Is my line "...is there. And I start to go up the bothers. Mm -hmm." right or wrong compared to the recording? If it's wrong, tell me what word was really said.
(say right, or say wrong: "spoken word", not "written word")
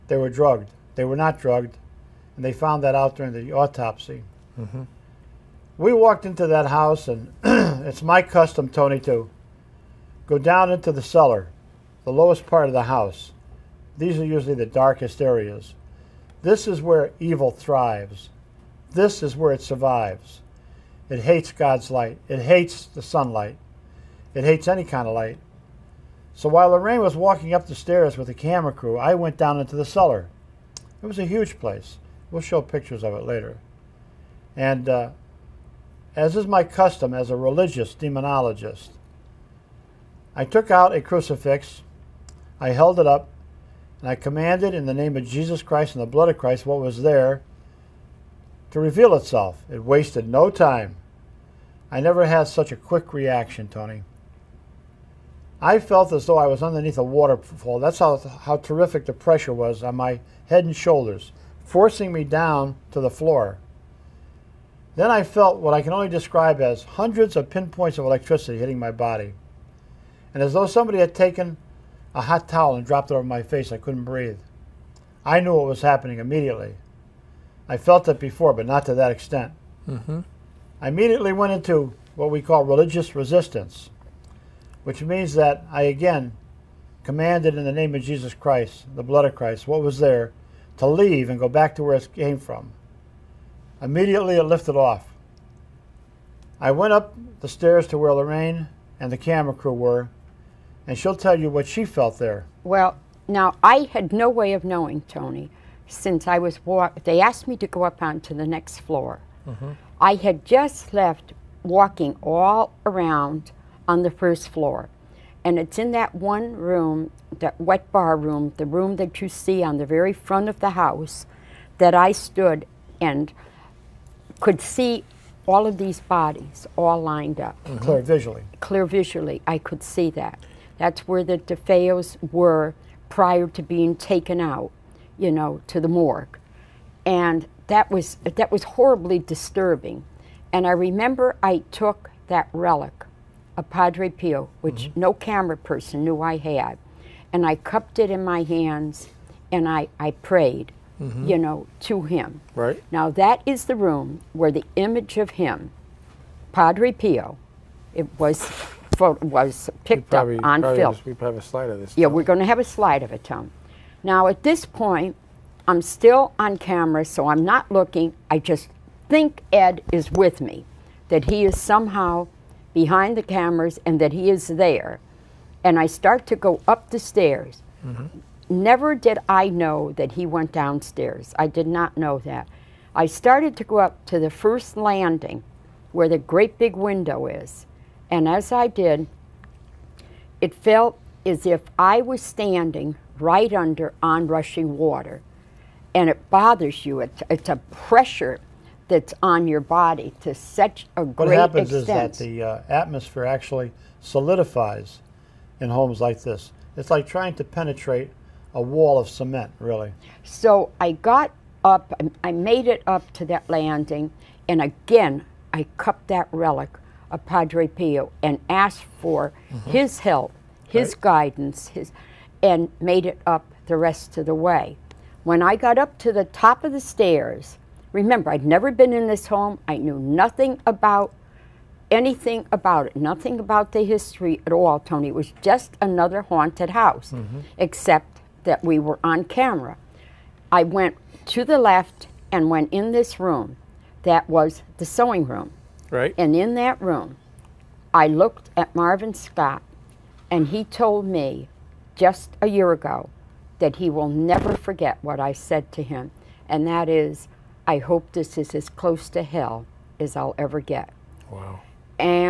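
wrong: "stairs", not "bothers".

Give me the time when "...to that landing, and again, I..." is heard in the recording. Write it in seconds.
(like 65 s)
213 s.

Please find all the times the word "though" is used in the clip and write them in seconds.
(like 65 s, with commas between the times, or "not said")
56 s, 70 s.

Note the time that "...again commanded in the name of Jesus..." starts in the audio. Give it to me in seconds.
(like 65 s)
85 s.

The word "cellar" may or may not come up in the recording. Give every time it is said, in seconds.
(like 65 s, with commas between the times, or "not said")
11 s, 29 s.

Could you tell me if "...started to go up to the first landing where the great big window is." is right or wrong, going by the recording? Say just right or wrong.
right.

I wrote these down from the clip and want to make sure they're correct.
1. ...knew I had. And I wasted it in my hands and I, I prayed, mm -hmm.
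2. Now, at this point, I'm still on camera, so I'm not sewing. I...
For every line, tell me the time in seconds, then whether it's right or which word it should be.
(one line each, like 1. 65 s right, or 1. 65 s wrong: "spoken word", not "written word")
1. 146 s wrong: "cupped", not "wasted"
2. 164 s wrong: "looking", not "sewing".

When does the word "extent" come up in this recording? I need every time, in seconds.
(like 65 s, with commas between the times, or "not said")
79 s, 201 s.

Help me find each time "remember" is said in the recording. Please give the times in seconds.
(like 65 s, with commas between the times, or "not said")
140 s, 227 s.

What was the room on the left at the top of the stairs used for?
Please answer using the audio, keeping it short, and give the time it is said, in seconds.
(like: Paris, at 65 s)
Sewing room, at 244 s.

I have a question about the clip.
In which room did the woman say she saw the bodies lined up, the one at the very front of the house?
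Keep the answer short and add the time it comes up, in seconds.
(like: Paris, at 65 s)
Wet bar room, at 117 s.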